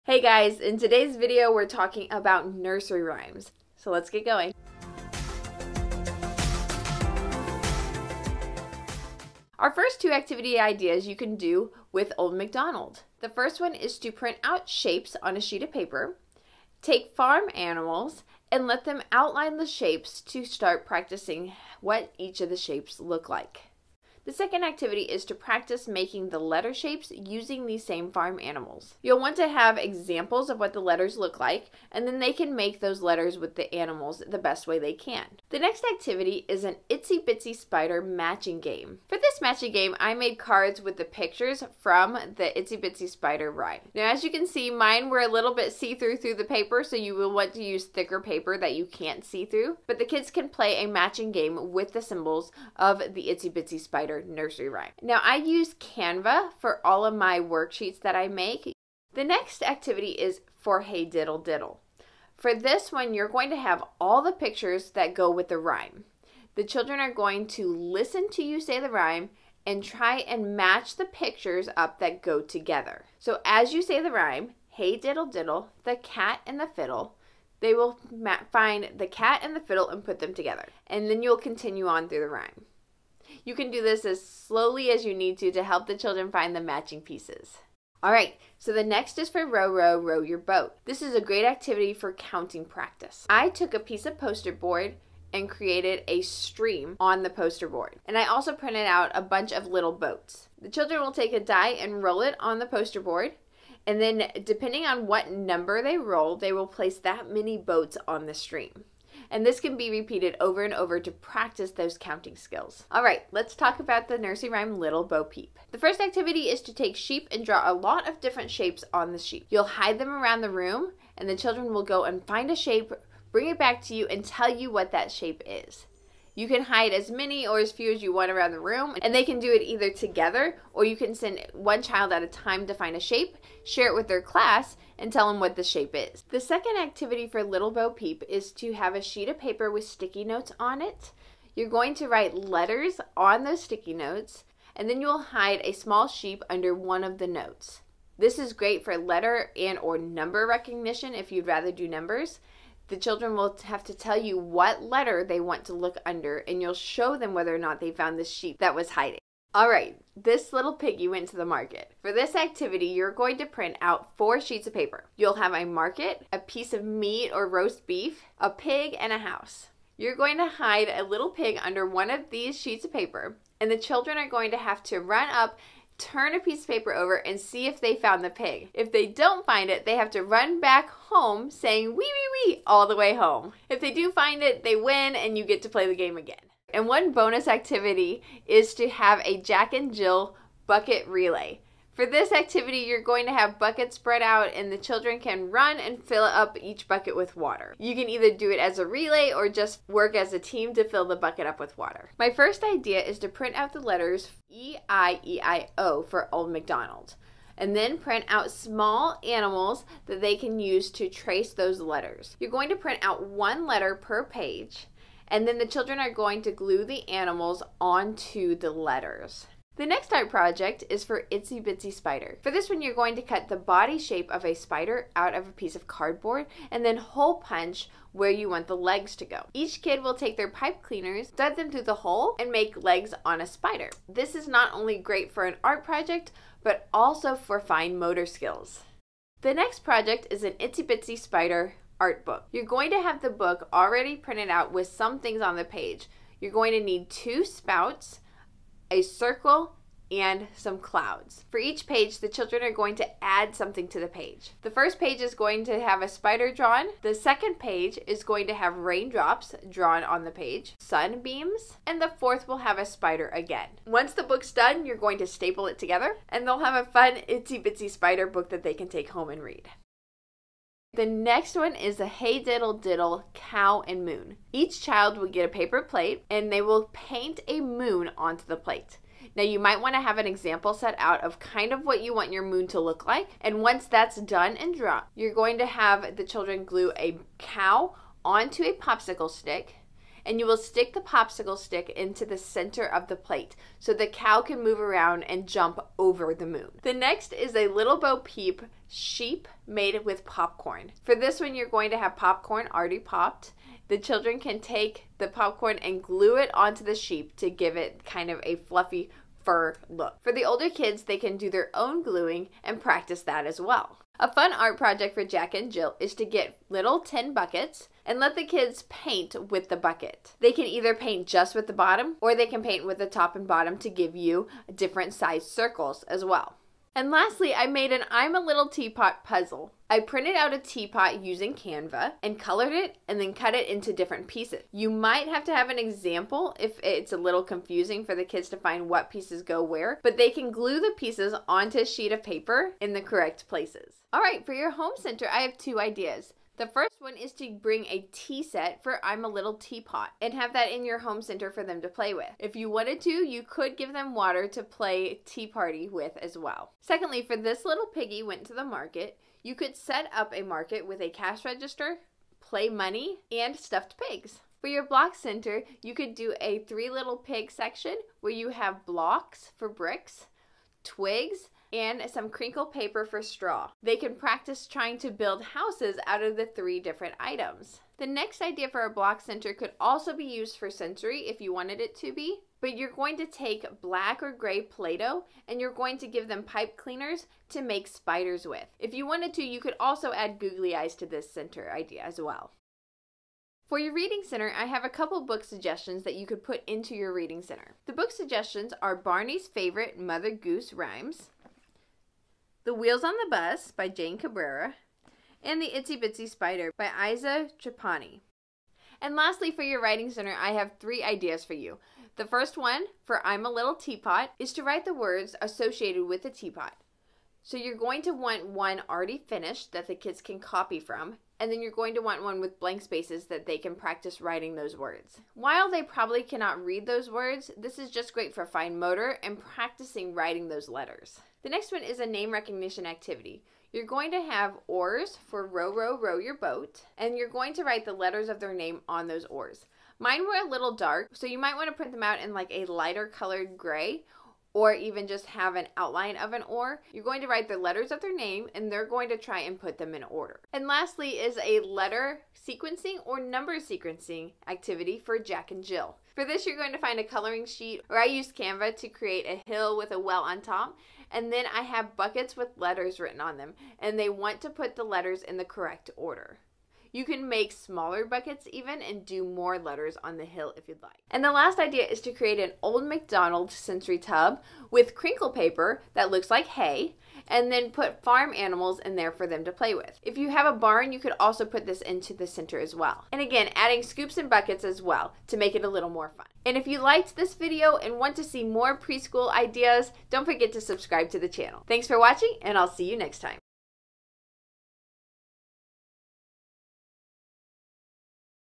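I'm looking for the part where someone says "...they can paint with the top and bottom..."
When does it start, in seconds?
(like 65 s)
322 s.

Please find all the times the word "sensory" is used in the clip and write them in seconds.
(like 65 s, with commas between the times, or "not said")
380 s, 473 s.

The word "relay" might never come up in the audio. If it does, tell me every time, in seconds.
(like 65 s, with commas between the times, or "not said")
191 s, 198 s.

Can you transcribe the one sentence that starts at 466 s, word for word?
You can make smaller buckets even and do more letters on the hill if you'd like.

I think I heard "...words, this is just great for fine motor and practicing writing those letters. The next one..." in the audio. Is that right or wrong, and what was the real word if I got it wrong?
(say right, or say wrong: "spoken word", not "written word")
right.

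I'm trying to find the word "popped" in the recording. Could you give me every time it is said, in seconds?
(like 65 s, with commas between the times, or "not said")
302 s.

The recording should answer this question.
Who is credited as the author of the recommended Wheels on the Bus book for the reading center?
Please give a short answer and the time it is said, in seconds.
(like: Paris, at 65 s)
Jane Cabrera, at 403 s.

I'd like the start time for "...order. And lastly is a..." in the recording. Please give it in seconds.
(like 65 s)
450 s.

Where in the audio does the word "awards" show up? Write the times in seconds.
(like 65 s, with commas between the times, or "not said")
not said.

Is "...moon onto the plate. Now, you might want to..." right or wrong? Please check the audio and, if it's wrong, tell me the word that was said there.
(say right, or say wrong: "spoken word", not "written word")
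right.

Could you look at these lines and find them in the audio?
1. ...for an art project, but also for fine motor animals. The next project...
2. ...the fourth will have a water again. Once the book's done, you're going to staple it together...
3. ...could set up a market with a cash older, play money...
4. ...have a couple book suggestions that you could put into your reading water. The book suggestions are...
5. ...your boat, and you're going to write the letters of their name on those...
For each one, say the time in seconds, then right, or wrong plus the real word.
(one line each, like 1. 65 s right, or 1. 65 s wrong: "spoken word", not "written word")
1. 235 s wrong: "skills", not "animals"
2. 262 s wrong: "spider", not "water"
3. 359 s wrong: "register", not "older"
4. 394 s wrong: "center", not "water"
5. 436 s right.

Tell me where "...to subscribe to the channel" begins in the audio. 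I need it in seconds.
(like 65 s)
490 s.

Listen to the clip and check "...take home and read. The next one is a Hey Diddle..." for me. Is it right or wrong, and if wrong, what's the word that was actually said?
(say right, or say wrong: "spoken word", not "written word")
right.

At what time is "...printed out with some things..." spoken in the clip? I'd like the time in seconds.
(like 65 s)
244 s.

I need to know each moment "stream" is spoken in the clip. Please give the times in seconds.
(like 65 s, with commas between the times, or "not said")
96 s, 108 s.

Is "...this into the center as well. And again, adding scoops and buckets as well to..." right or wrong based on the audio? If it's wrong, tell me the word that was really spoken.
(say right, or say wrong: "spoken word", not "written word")
right.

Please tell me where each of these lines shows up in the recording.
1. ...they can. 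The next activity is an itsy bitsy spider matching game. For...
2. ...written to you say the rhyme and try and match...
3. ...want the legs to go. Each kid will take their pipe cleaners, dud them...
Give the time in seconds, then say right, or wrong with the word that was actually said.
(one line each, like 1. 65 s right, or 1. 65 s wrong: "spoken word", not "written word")
1. 34 s right
2. 67 s wrong: "listen", not "written"
3. 228 s right.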